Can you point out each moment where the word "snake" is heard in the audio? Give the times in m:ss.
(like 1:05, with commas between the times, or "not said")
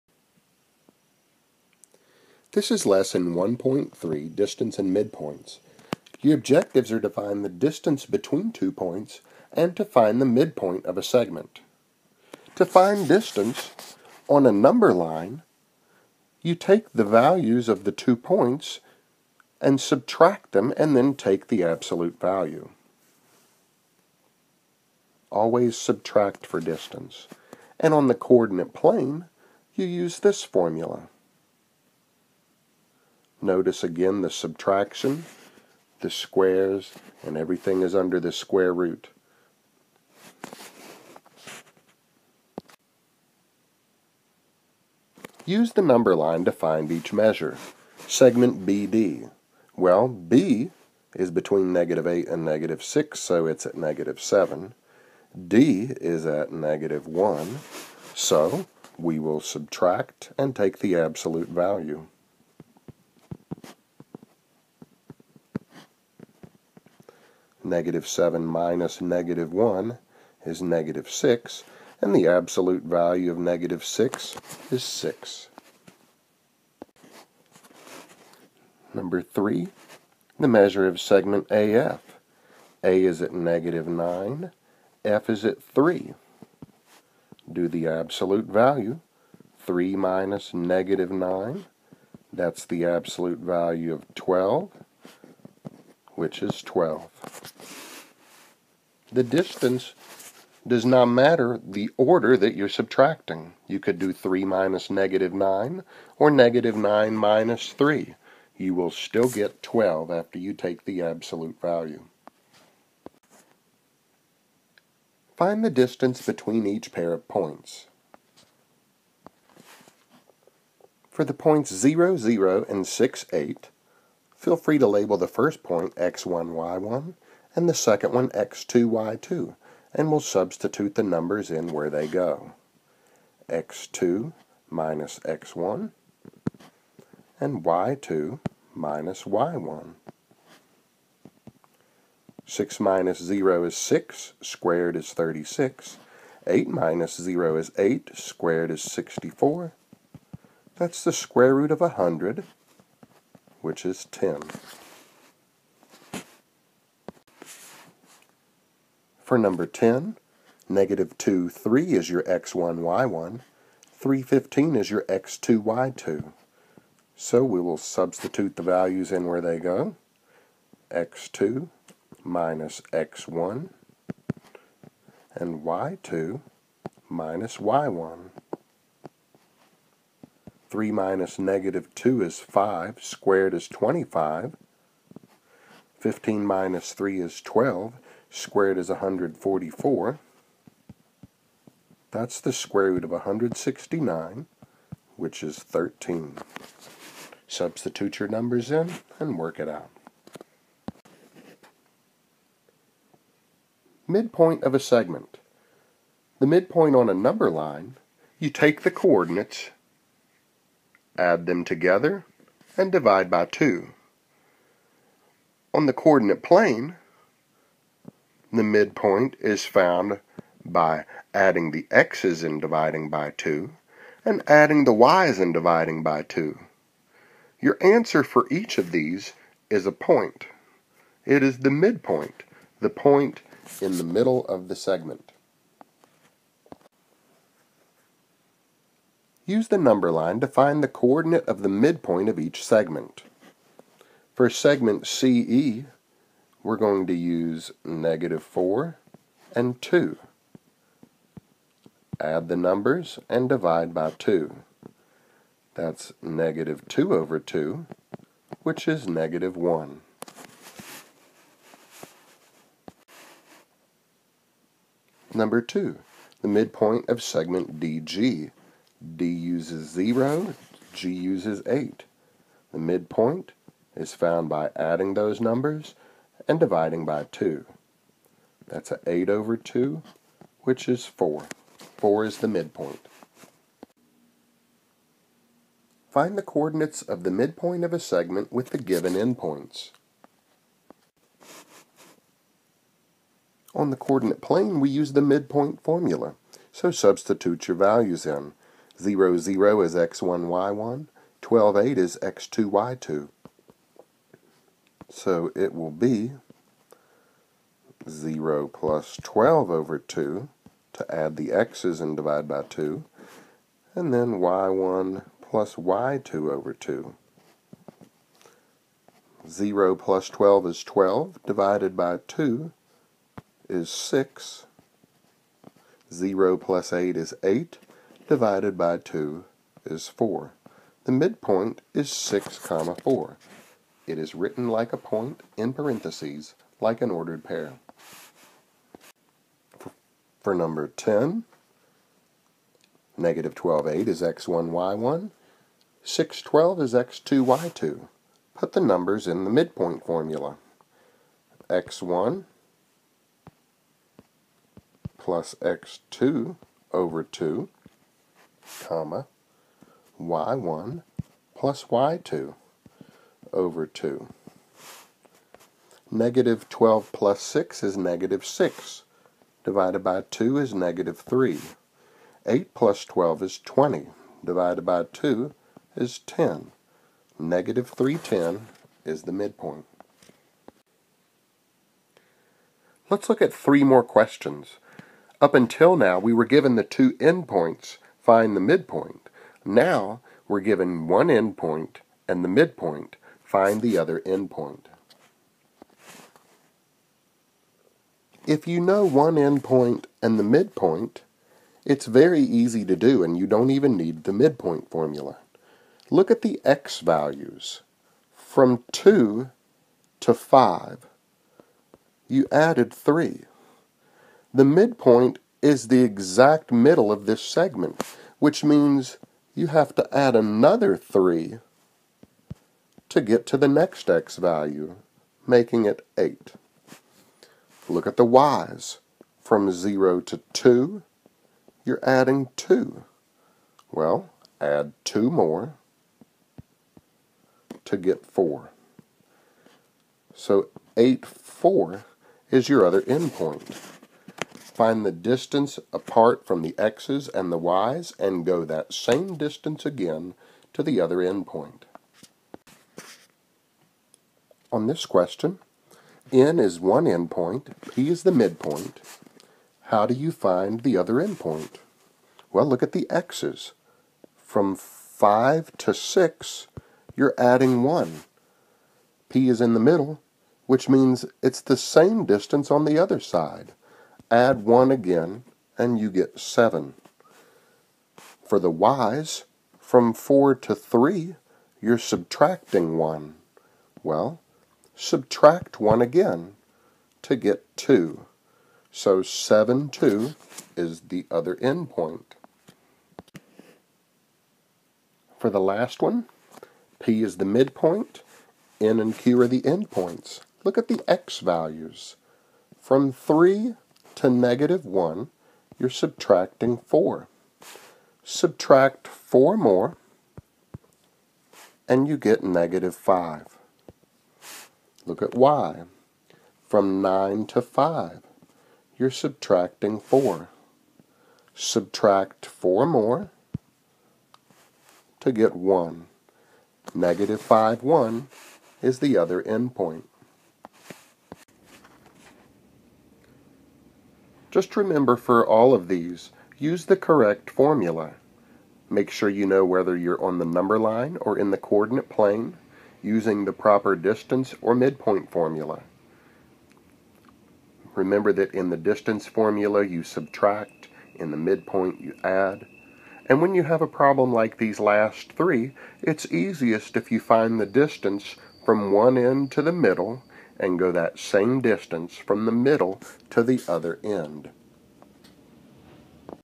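not said.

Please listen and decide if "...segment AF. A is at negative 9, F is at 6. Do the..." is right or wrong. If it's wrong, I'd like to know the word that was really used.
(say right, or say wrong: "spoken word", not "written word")
wrong: "3", not "6".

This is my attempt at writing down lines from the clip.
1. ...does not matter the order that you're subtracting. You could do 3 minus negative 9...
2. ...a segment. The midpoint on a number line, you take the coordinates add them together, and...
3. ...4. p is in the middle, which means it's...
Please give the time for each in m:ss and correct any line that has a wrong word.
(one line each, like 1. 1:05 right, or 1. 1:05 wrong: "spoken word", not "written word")
1. 1:40 right
2. 3:24 right
3. 7:47 wrong: "1", not "4".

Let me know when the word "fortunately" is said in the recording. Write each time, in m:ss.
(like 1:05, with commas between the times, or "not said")
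not said.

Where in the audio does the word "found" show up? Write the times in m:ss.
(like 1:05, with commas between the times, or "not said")
3:39, 4:34.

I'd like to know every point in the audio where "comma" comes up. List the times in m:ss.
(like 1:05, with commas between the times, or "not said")
5:32, 5:58.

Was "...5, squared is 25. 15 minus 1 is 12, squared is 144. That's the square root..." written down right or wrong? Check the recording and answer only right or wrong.
wrong.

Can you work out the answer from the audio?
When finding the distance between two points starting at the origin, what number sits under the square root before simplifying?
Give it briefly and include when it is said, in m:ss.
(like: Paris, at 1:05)
100, at 2:31.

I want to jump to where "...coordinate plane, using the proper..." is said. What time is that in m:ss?
9:01.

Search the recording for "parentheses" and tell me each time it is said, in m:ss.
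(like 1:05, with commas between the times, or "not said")
5:35.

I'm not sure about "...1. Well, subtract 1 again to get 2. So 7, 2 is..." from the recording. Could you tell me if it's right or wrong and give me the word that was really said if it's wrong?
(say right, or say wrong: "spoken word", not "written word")
right.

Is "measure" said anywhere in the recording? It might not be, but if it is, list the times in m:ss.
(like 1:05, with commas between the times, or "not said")
0:47, 1:20.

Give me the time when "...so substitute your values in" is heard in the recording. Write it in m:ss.
4:56.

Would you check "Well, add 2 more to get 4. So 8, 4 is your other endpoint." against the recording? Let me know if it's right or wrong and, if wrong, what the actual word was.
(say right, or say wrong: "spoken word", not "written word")
right.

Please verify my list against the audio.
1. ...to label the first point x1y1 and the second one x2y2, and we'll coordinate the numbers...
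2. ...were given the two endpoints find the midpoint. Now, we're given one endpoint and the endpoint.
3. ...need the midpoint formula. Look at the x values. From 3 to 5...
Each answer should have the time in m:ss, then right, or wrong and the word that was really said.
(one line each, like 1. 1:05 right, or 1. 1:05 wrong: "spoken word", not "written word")
1. 2:04 wrong: "substitute", not "coordinate"
2. 6:26 wrong: "midpoint", not "endpoint"
3. 6:43 wrong: "2", not "3".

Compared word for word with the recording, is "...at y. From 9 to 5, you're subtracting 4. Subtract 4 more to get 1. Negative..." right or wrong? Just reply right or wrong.
right.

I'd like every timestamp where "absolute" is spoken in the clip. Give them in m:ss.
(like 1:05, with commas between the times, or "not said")
0:21, 1:00, 1:12, 1:27, 1:32, 1:51.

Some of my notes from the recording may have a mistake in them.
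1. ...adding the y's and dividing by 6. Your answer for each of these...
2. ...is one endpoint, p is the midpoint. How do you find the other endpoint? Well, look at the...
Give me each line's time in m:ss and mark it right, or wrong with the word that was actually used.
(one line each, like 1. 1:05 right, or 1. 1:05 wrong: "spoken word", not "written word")
1. 3:44 wrong: "2", not "6"
2. 7:36 right.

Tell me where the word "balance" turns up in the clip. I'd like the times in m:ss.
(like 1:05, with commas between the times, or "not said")
not said.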